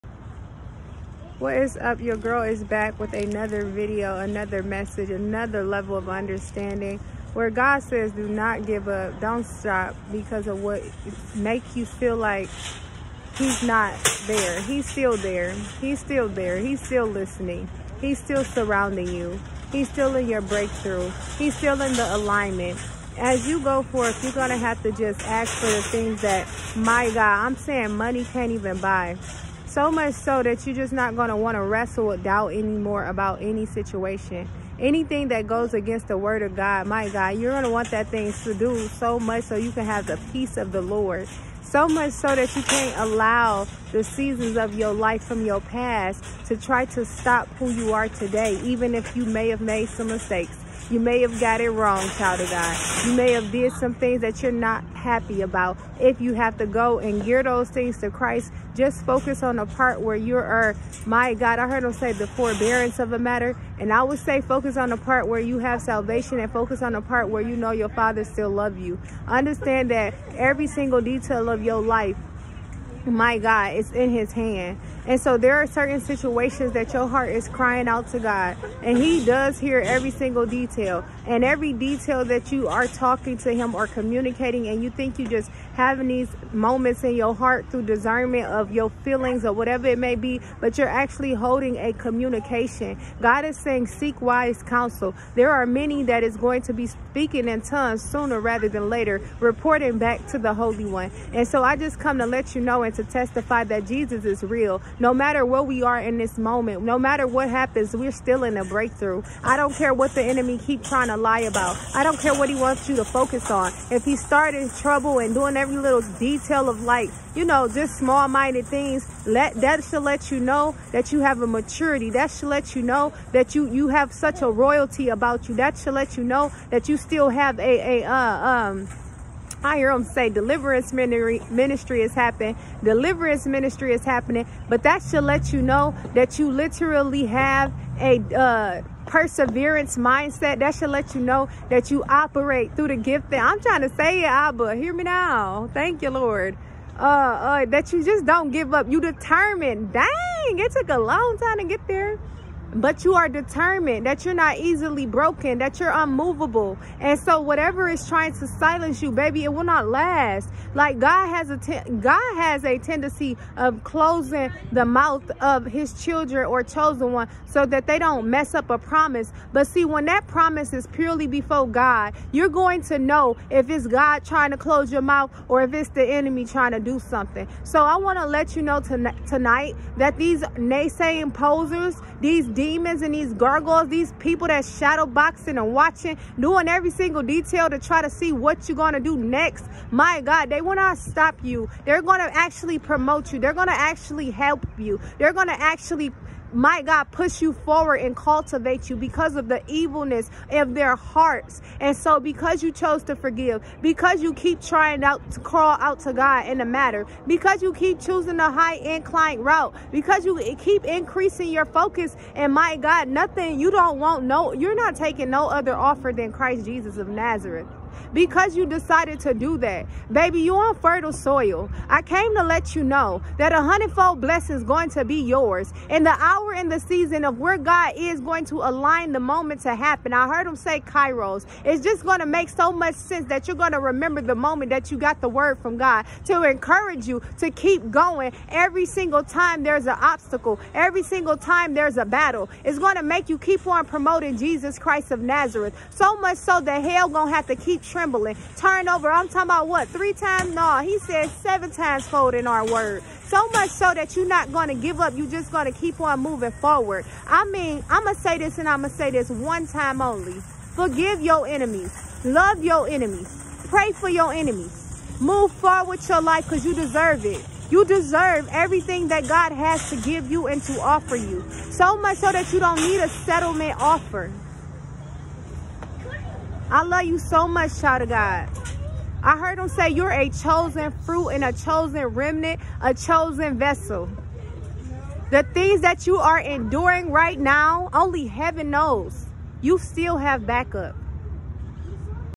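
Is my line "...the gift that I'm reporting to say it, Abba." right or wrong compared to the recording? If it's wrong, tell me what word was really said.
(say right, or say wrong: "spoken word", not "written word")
wrong: "trying", not "reporting".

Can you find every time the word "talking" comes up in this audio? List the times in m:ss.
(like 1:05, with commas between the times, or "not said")
1:22, 4:09.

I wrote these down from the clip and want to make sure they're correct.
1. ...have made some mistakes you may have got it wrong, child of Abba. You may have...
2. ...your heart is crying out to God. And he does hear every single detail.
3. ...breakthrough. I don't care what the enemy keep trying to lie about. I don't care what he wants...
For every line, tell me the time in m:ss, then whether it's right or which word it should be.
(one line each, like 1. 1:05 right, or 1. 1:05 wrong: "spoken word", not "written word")
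1. 0:49 wrong: "God", not "Abba"
2. 1:16 right
3. 1:48 right.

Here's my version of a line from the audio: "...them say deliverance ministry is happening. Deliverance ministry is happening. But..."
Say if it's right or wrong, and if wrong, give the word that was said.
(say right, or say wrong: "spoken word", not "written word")
right.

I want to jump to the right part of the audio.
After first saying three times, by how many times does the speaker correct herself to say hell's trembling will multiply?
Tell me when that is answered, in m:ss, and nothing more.
4:11.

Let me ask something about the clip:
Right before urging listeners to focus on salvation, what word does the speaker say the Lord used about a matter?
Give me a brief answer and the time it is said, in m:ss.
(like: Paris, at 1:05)
forbearance, at 1:02.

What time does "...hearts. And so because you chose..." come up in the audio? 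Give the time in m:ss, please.
3:20.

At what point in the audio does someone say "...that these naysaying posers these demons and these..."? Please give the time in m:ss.
2:59.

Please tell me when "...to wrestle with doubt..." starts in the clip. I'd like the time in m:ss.
0:31.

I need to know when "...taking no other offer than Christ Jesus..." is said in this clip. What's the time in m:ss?
3:34.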